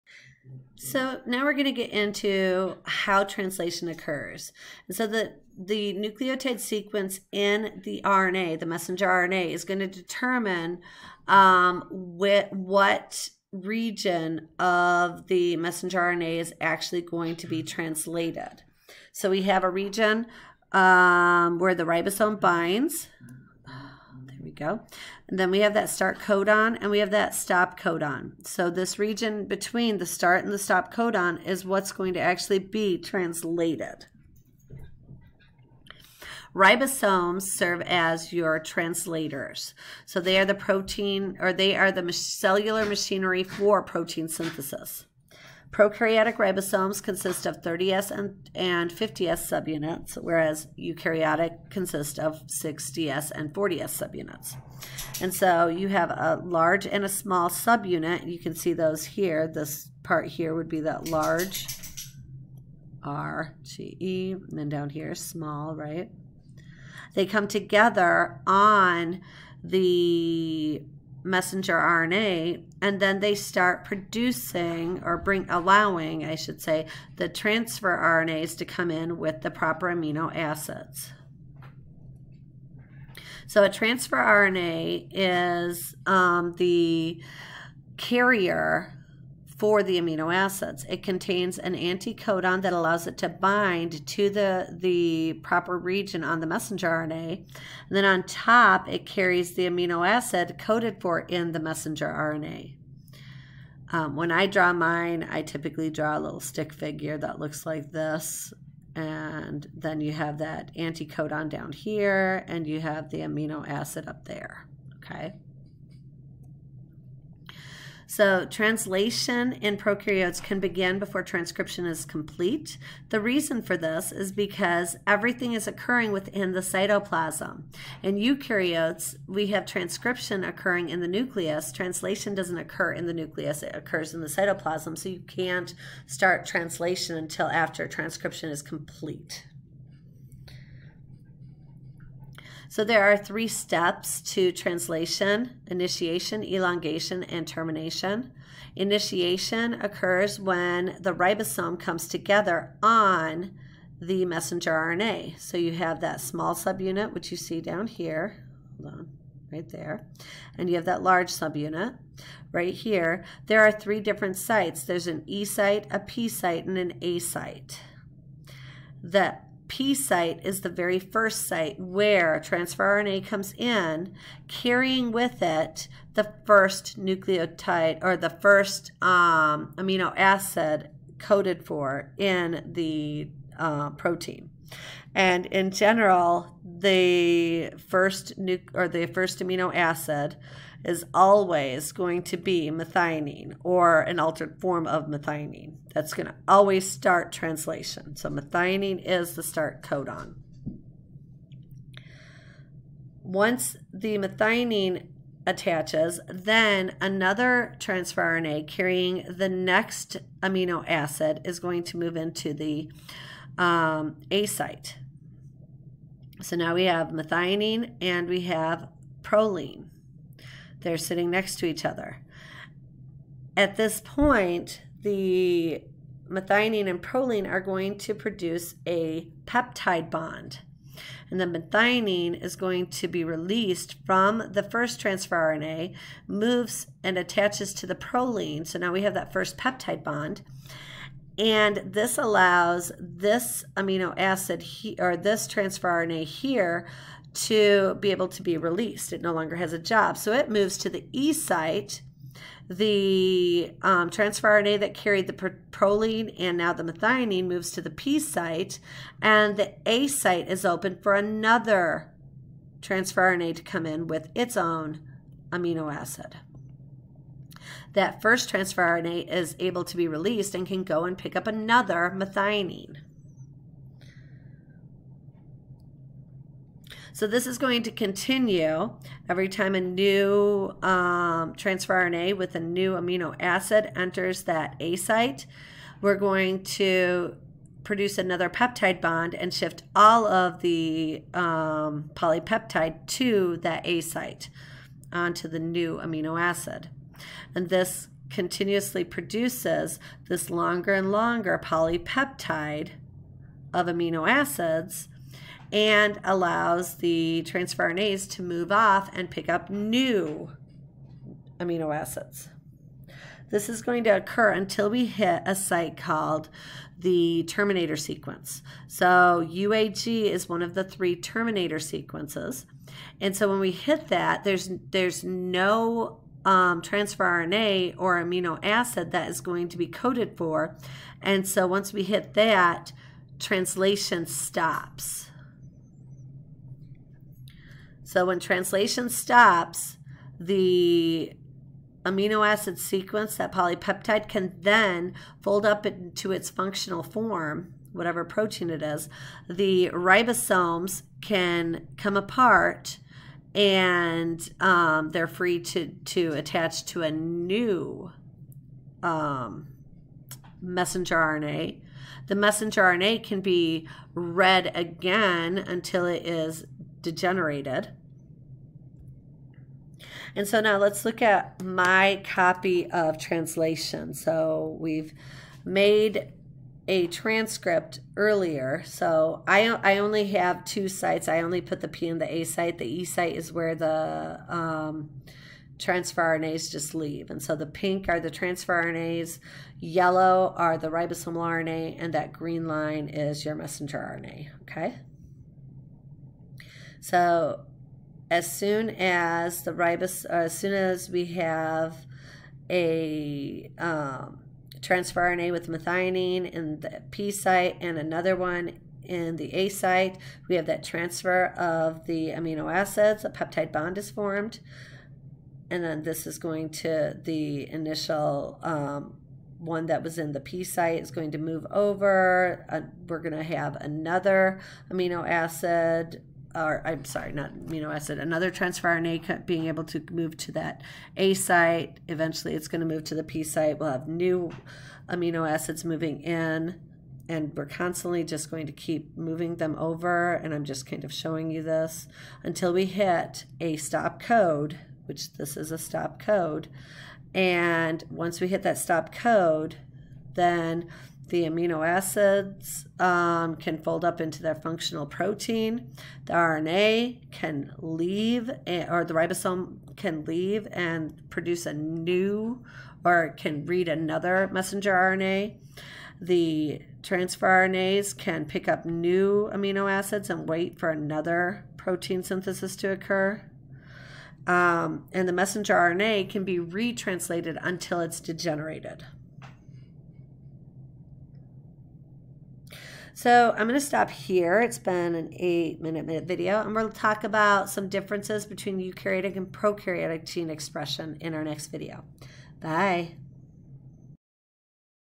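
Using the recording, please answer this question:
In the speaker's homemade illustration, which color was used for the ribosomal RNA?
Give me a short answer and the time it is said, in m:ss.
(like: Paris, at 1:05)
yellow, at 6:29.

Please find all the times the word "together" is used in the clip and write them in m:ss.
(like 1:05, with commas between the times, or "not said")
1:07, 2:32.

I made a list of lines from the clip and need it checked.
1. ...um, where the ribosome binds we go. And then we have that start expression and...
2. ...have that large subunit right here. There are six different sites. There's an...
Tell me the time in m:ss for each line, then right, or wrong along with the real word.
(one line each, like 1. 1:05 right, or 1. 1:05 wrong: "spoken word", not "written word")
1. 0:20 wrong: "codon", not "expression"
2. 2:40 wrong: "three", not "six".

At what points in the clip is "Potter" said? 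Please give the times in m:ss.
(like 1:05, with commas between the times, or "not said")
not said.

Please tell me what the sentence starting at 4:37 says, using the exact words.
So this is going to continue every time a new um, transfer RNA with a new amino acid enters that A site.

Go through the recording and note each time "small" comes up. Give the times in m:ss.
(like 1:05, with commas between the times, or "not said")
0:57, 1:05, 2:36.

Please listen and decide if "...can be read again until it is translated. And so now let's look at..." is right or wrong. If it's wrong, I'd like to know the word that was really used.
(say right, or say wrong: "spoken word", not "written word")
wrong: "degenerated", not "translated".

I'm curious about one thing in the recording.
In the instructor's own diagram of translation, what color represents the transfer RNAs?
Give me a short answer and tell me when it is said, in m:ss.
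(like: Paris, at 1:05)
pink, at 6:27.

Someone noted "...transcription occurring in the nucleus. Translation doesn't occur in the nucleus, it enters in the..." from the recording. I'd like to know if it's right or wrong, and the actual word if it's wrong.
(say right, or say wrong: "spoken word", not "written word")
wrong: "occurs", not "enters".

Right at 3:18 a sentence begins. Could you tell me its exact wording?
So methionine is the start codon.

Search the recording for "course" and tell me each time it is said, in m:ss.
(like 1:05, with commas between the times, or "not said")
not said.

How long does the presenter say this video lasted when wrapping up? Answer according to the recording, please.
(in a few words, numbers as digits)
8 minutes.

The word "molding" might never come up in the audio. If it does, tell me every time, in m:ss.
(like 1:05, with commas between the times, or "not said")
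not said.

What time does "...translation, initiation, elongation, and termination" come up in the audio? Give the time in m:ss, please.
2:24.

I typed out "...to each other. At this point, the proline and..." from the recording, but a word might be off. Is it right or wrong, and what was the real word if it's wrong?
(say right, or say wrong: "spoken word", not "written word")
wrong: "methionine", not "proline".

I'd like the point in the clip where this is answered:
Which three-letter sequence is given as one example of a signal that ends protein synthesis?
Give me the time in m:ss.
5:19.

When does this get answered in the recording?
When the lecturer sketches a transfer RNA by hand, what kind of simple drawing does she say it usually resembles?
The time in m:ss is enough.
1:46.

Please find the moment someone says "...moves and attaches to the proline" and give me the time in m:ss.
3:56.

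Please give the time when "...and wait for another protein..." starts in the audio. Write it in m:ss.
7:50.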